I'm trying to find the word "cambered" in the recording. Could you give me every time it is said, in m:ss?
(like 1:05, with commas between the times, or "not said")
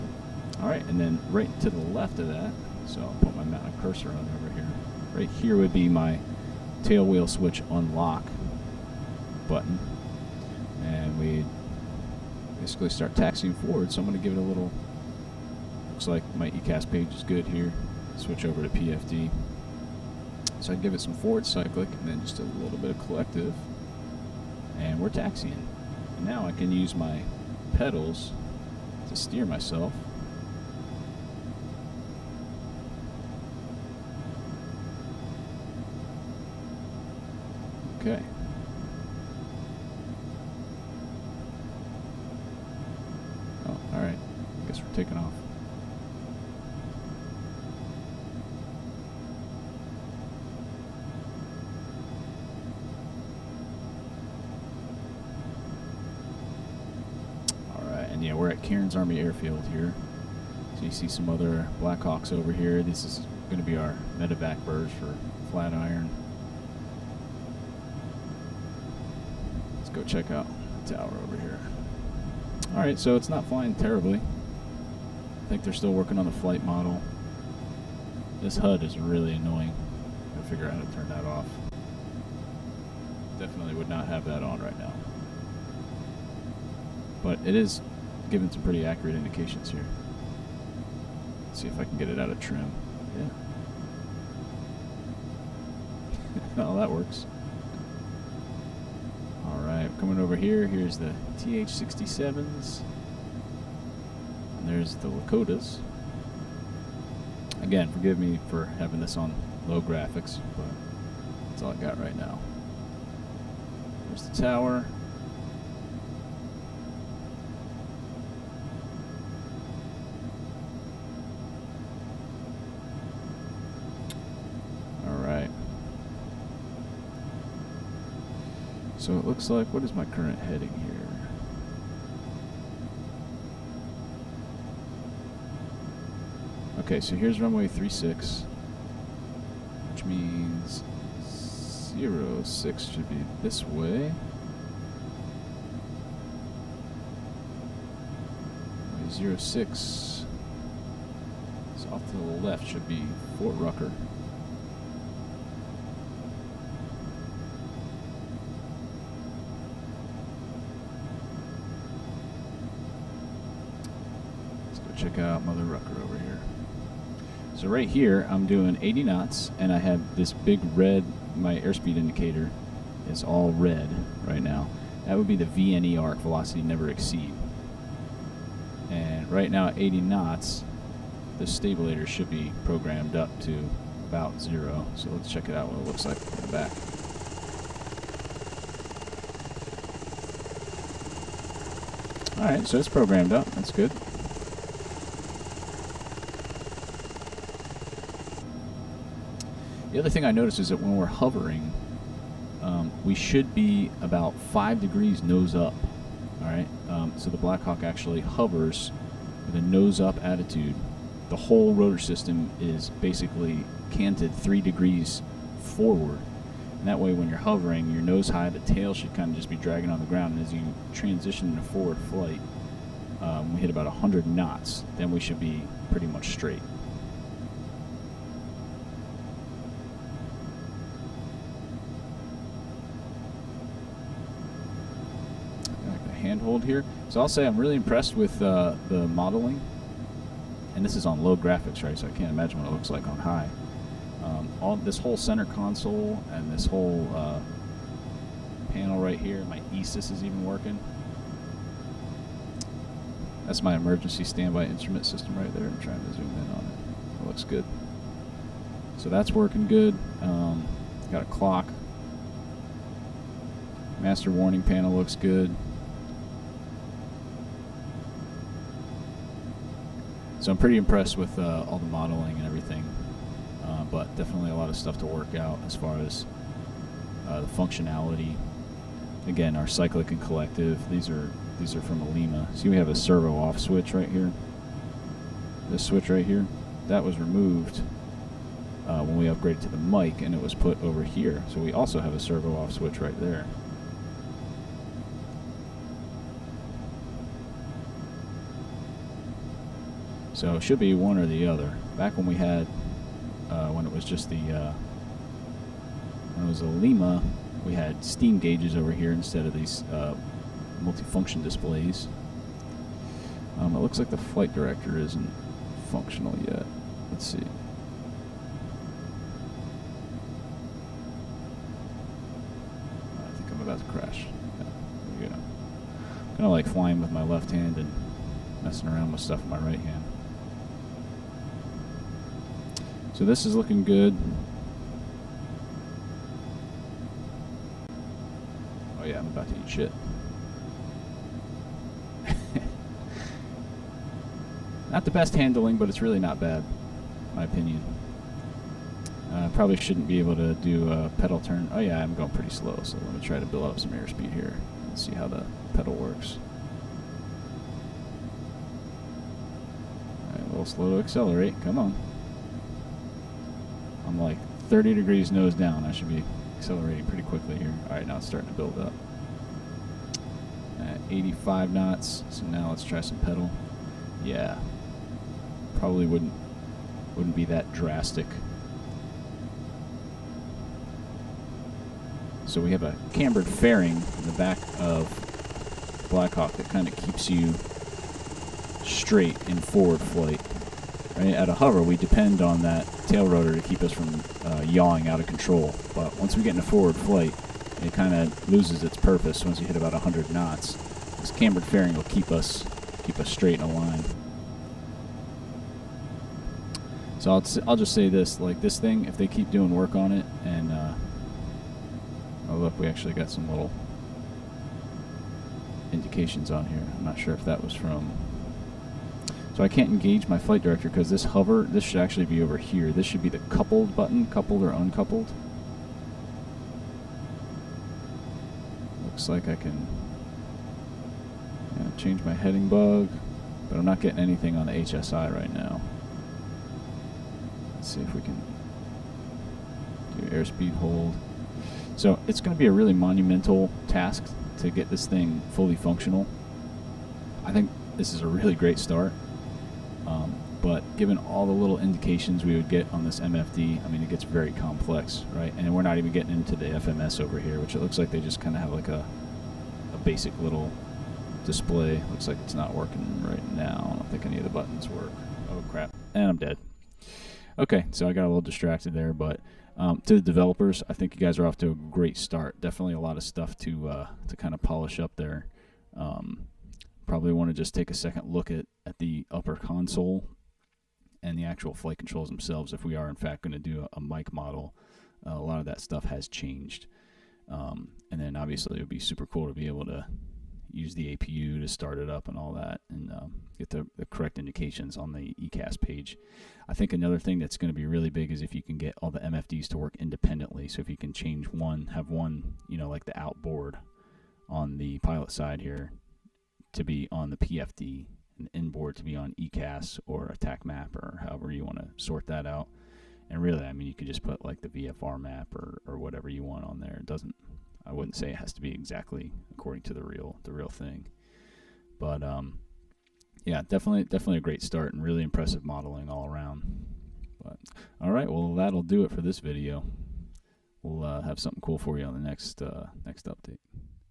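6:23, 6:41.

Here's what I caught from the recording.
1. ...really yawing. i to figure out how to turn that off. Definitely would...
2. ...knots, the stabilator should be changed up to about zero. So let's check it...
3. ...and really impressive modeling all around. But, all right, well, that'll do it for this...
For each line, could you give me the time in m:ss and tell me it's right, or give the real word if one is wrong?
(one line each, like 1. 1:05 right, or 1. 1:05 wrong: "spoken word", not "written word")
1. 1:18 wrong: "annoying", not "yawing"
2. 3:00 wrong: "programmed", not "changed"
3. 8:44 right.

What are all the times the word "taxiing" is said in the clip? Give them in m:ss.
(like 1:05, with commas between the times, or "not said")
0:13, 0:25.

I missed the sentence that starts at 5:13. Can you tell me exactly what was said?
Um, it looks like the flight director isn't functional yet.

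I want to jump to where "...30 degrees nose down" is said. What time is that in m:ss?
6:04.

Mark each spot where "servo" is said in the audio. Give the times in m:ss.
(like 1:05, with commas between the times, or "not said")
4:42, 4:52.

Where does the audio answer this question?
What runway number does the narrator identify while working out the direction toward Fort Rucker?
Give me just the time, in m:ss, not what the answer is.
2:17.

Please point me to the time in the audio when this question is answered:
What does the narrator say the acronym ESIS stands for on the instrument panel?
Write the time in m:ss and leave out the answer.
4:13.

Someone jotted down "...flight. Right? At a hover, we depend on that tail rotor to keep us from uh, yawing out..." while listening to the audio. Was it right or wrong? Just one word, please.
right.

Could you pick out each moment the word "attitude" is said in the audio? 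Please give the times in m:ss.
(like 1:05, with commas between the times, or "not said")
3:30.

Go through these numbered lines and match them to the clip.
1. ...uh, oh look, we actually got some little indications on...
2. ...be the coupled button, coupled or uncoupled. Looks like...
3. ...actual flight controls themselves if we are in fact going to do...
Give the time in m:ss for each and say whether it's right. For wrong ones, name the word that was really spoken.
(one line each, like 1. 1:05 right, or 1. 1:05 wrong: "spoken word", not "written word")
1. 6:50 right
2. 7:03 right
3. 8:01 right.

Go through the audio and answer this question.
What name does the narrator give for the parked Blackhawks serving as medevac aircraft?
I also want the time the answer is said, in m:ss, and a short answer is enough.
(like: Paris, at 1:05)
Flatiron, at 1:05.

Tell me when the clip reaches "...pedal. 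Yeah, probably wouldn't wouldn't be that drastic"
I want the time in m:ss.
6:13.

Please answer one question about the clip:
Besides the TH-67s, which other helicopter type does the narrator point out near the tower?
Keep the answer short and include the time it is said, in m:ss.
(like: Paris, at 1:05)
Lakotas, at 1:45.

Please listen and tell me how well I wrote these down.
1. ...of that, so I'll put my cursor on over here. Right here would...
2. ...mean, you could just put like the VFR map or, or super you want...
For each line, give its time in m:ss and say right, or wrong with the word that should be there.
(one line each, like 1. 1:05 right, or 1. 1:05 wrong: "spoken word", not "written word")
1. 0:02 right
2. 8:33 wrong: "whatever", not "super".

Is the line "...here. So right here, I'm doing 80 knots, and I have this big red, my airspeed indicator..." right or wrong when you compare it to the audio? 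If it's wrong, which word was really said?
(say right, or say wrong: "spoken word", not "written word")
right.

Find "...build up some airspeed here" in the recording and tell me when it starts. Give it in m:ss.
5:53.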